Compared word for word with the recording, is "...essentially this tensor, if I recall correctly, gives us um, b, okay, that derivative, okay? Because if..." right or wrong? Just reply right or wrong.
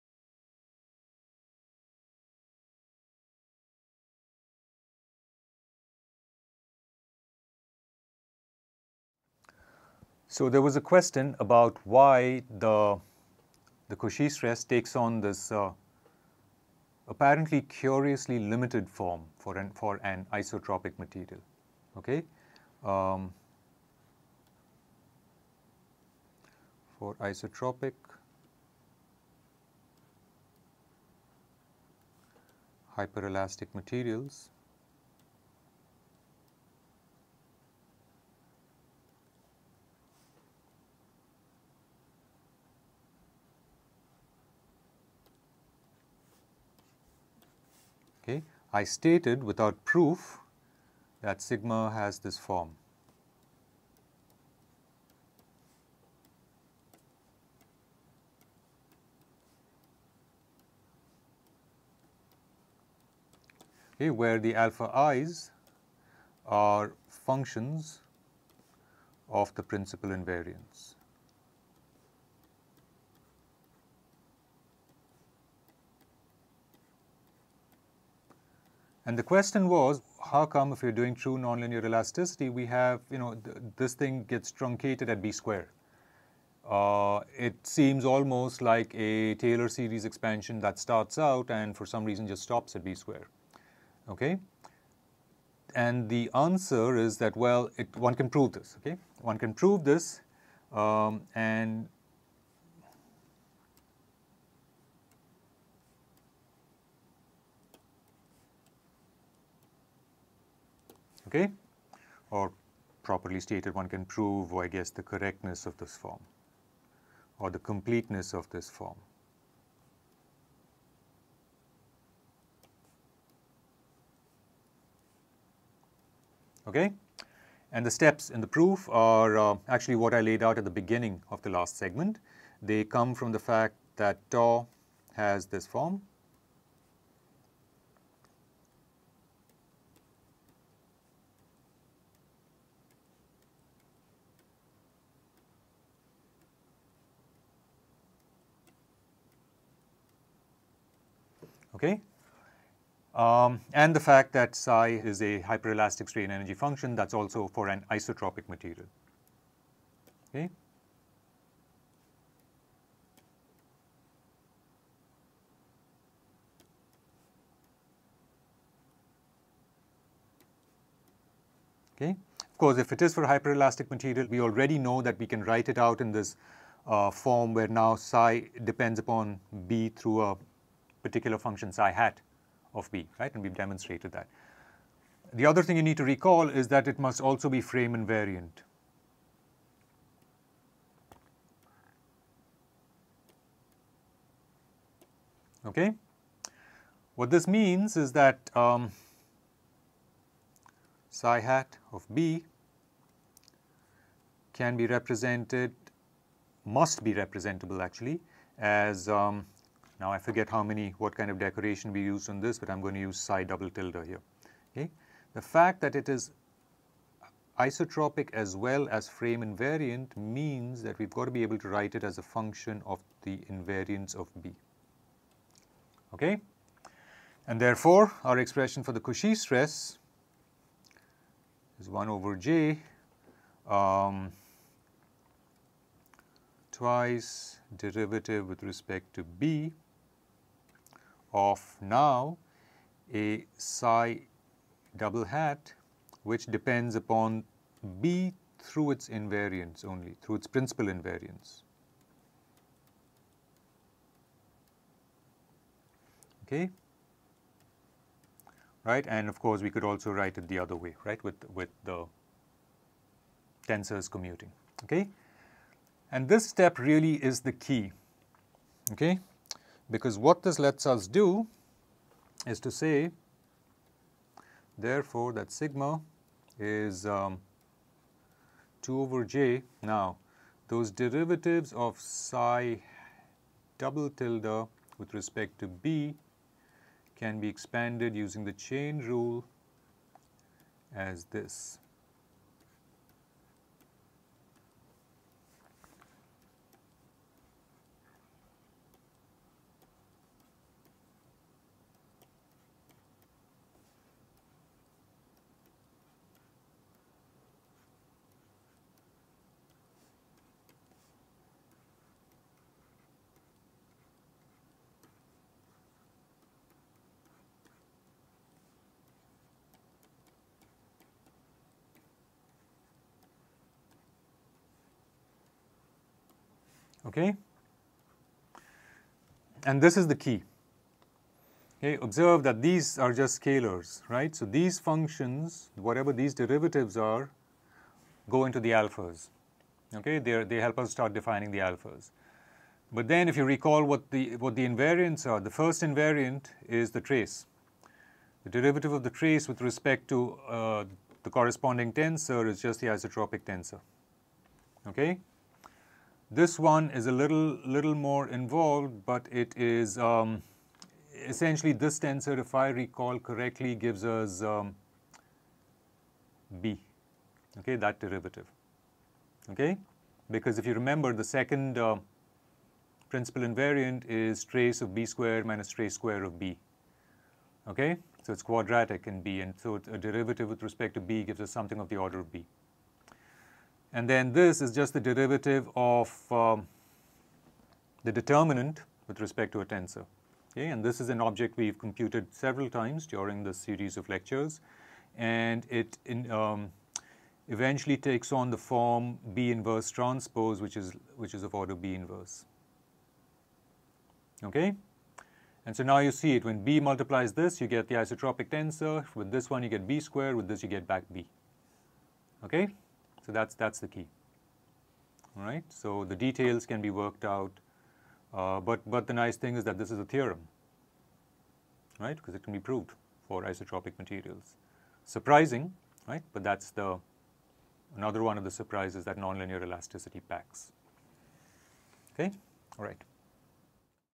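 right.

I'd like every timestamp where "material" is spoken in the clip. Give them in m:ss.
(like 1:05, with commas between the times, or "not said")
0:20, 0:33, 2:38, 2:53, 7:03.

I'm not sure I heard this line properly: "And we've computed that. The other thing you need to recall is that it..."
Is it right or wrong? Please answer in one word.
wrong.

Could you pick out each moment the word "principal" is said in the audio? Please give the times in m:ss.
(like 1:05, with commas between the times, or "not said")
1:09, 4:10, 6:13.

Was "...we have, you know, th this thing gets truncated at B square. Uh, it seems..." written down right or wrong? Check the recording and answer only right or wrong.
right.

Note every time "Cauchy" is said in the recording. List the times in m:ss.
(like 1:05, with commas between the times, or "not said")
0:13, 3:48.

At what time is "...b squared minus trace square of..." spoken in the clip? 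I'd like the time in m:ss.
6:14.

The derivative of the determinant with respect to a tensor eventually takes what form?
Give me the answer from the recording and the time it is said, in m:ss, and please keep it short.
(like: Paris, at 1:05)
B inverse transpose, at 6:39.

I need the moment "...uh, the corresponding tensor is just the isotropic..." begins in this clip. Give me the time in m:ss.
5:50.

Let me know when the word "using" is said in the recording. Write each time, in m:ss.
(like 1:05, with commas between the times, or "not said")
4:48.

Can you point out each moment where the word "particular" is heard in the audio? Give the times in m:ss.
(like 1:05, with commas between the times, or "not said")
3:01.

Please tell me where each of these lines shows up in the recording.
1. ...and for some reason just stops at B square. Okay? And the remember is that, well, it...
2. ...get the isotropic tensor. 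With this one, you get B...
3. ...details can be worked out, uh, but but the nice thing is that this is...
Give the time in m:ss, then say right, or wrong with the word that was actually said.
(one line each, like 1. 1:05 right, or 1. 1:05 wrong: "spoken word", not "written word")
1. 1:31 wrong: "answer", not "remember"
2. 6:47 right
3. 6:56 right.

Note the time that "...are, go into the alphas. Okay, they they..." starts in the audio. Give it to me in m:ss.
5:36.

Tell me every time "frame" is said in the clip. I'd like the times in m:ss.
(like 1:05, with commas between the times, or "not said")
3:07, 3:39.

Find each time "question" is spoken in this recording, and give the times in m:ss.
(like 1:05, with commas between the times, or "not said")
0:10, 1:19.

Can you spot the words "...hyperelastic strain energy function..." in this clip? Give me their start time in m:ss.
2:35.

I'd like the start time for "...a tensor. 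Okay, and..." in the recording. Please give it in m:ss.
6:29.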